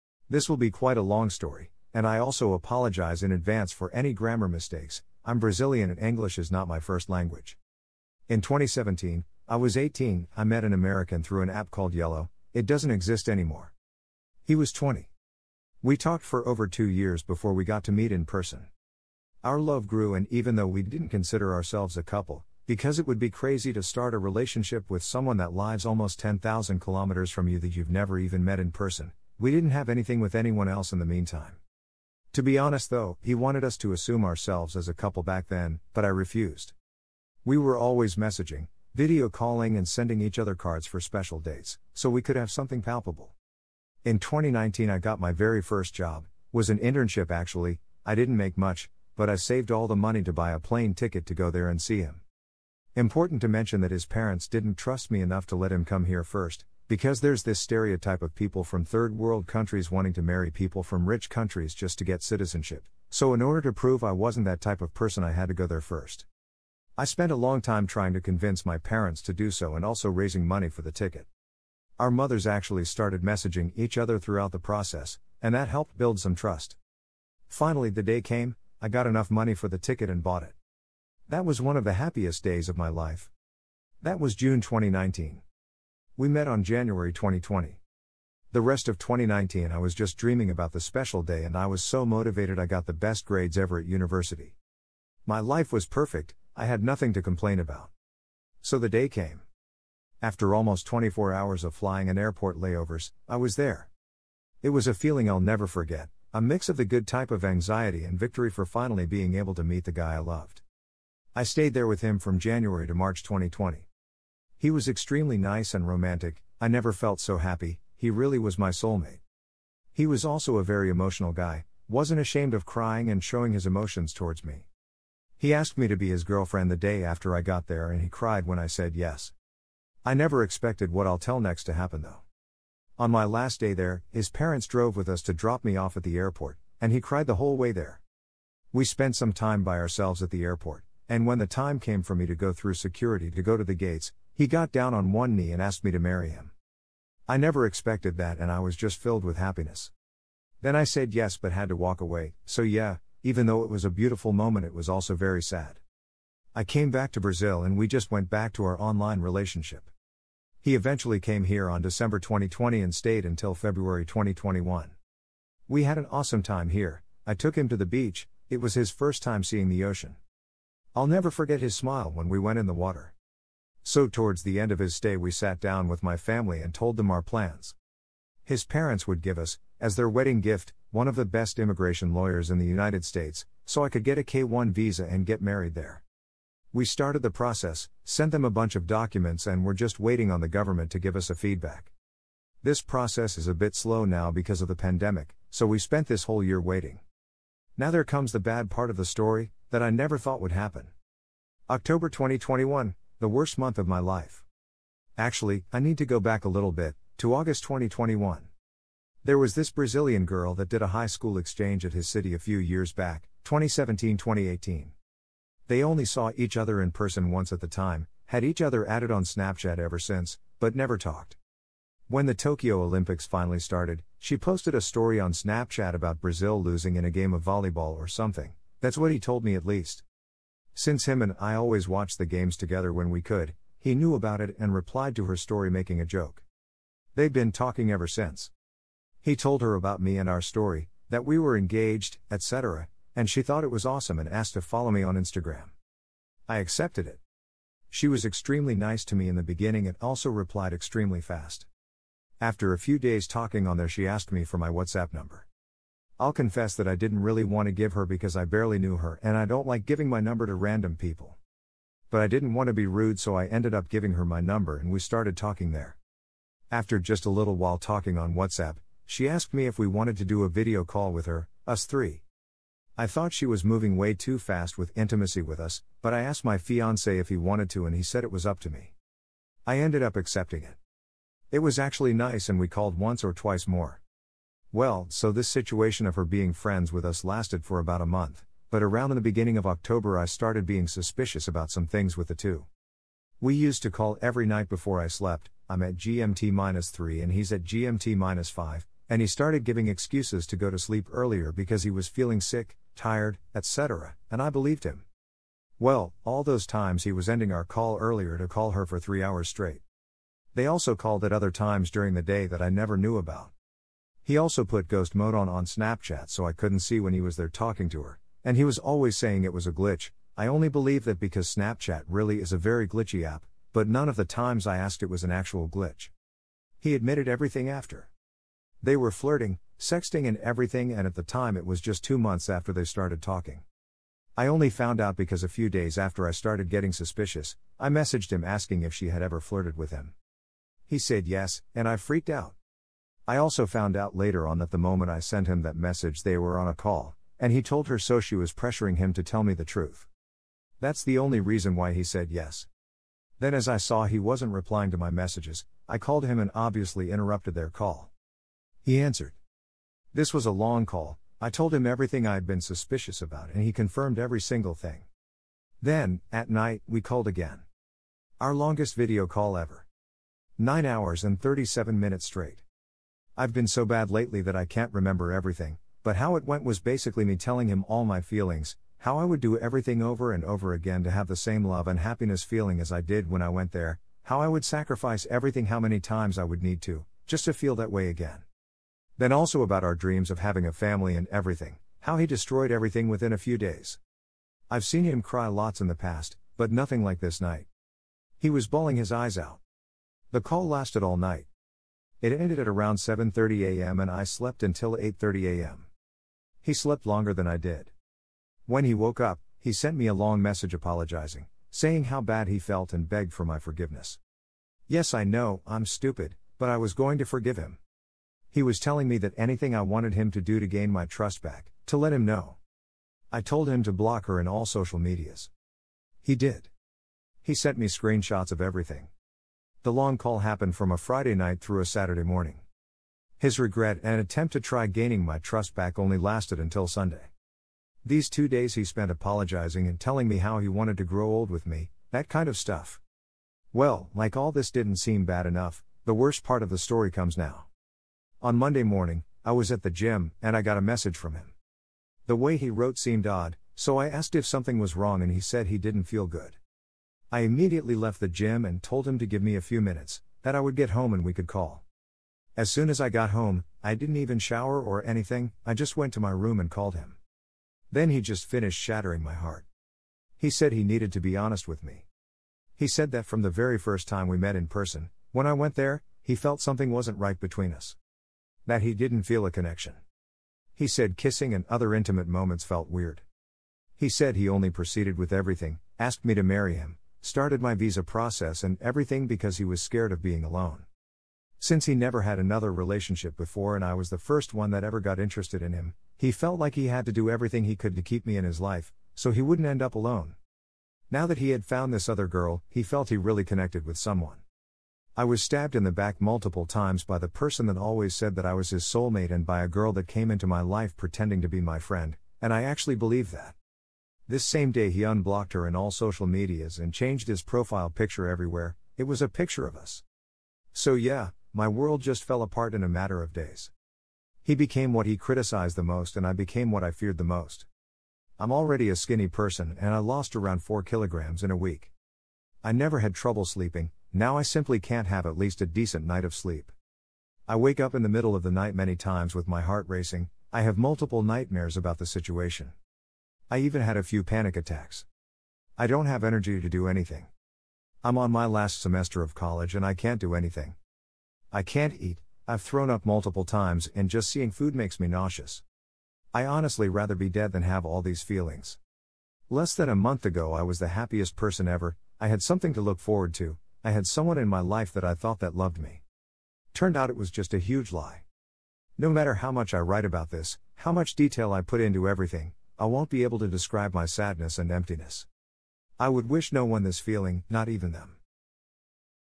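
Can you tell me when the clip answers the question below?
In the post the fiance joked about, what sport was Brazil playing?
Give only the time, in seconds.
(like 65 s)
227 s.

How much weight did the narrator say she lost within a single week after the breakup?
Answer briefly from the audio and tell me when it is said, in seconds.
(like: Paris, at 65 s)
4 kilograms, at 530 s.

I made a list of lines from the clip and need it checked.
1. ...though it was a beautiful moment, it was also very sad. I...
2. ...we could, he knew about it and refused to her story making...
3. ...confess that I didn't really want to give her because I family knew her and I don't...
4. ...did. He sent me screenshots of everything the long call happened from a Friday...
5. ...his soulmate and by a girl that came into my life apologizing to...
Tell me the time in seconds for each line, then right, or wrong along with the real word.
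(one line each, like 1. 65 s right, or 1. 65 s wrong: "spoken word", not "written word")
1. 153 s right
2. 233 s wrong: "replied", not "refused"
3. 256 s wrong: "barely", not "family"
4. 426 s right
5. 508 s wrong: "pretending", not "apologizing".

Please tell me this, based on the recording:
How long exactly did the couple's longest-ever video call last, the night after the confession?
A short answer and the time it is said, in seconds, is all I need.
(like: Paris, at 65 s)
9 hours 37 minutes, at 370 s.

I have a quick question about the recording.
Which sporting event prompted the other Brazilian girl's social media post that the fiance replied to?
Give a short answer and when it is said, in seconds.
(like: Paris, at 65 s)
Tokyo Olympics, at 222 s.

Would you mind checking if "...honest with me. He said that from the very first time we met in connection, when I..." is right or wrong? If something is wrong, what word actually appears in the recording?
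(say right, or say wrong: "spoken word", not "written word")
wrong: "person", not "connection".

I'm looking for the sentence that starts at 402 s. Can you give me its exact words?
It ended at around 7:30 a.m.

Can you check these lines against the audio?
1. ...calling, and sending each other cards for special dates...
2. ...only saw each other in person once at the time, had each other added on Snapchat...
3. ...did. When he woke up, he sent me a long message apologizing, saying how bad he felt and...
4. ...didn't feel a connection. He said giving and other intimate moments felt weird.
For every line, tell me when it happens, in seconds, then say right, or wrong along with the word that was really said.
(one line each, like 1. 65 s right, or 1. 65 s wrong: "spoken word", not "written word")
1. 39 s right
2. 215 s right
3. 407 s right
4. 478 s wrong: "kissing", not "giving".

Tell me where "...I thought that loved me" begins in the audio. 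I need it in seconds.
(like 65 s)
565 s.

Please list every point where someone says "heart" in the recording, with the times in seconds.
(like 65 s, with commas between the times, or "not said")
469 s, 539 s.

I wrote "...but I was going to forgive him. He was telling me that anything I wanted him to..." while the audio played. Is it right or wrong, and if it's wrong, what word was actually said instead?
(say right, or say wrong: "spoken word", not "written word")
right.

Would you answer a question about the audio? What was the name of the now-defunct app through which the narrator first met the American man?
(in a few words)
Yellow.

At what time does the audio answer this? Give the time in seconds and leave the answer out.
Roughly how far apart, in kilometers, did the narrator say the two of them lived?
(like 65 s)
26 s.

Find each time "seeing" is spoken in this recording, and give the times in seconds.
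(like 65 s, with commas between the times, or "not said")
169 s, 554 s.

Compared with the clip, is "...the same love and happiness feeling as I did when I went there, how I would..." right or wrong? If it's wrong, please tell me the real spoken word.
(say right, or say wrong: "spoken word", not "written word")
right.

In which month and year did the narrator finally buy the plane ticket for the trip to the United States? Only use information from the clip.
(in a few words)
June 2019.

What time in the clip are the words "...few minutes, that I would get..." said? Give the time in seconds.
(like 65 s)
459 s.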